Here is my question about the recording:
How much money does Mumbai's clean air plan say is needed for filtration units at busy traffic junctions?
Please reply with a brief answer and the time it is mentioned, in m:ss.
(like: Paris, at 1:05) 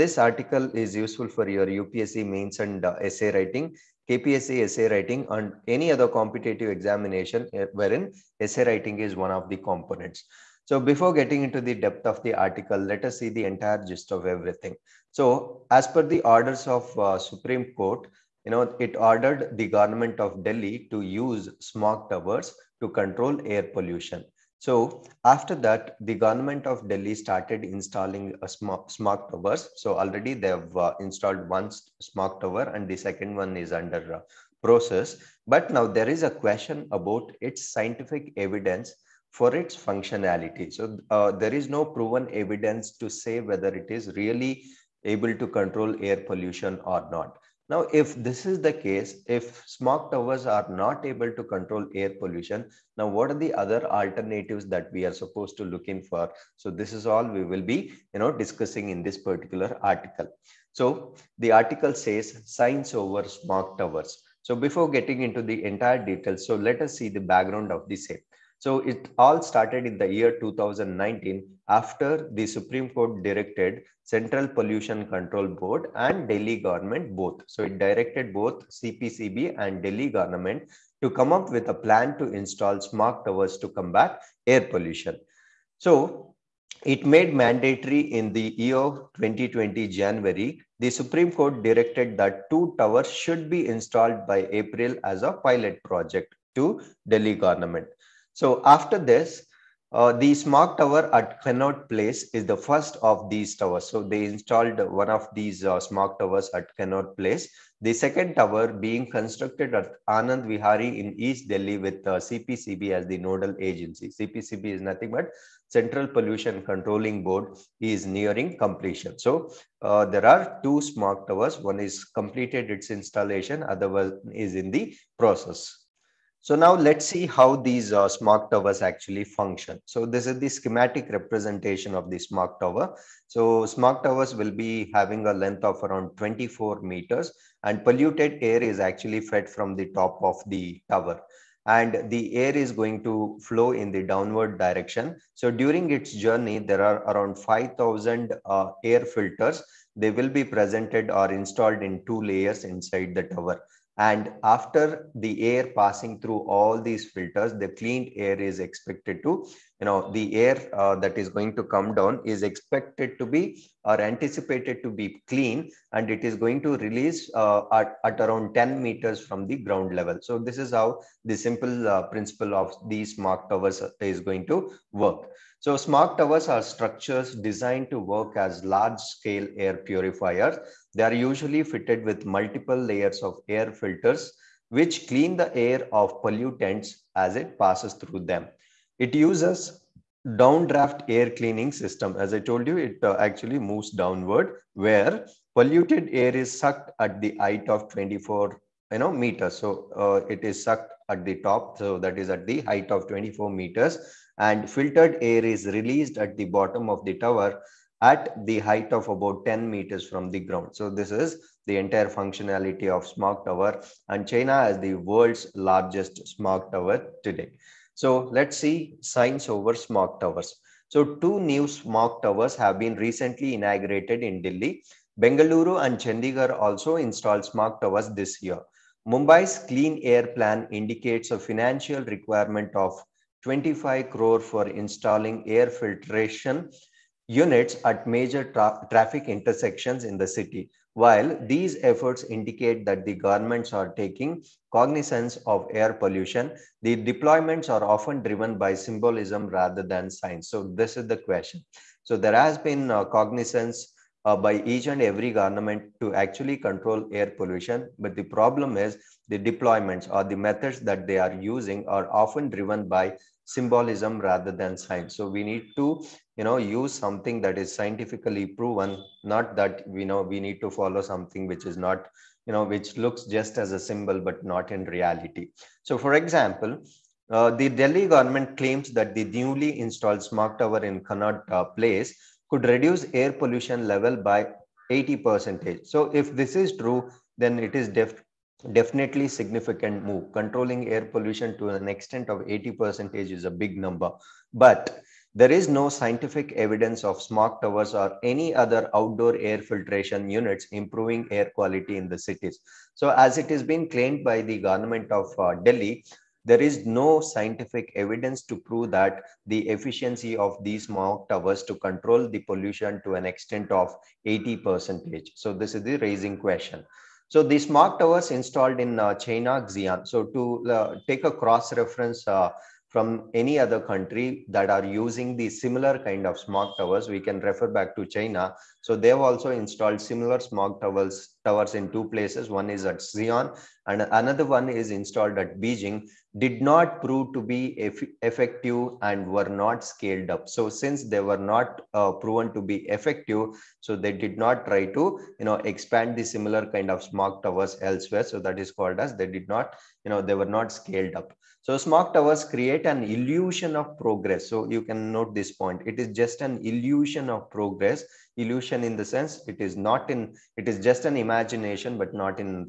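25 crore, at 3:53.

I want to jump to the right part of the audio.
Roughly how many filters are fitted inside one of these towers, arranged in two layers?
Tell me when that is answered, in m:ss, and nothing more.
2:27.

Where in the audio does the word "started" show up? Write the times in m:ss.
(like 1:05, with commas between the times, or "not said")
0:27, 1:09.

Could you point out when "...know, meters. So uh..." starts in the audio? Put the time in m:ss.
3:18.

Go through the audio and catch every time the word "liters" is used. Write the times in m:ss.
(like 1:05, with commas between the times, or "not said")
not said.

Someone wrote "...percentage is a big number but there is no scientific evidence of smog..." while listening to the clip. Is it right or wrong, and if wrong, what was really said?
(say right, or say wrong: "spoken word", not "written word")
right.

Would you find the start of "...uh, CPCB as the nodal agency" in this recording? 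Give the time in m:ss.
1:52.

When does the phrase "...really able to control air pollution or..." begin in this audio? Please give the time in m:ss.
0:44.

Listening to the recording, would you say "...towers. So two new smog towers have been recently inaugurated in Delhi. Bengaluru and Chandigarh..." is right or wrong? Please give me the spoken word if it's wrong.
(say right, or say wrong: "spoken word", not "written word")
right.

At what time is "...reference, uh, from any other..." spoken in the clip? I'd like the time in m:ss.
5:21.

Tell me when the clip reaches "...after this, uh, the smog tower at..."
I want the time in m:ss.
1:38.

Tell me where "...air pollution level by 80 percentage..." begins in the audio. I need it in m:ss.
4:43.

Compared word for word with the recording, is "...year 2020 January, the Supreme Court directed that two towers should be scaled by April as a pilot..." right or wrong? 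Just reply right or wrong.
wrong.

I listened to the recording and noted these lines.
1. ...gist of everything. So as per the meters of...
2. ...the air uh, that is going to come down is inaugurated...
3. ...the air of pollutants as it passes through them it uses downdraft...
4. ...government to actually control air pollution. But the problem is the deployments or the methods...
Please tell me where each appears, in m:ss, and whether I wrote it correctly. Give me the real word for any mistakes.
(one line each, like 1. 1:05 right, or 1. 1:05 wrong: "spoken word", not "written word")
1. 0:13 wrong: "orders", not "meters"
2. 2:40 wrong: "expected", not "inaugurated"
3. 3:05 right
4. 4:15 right.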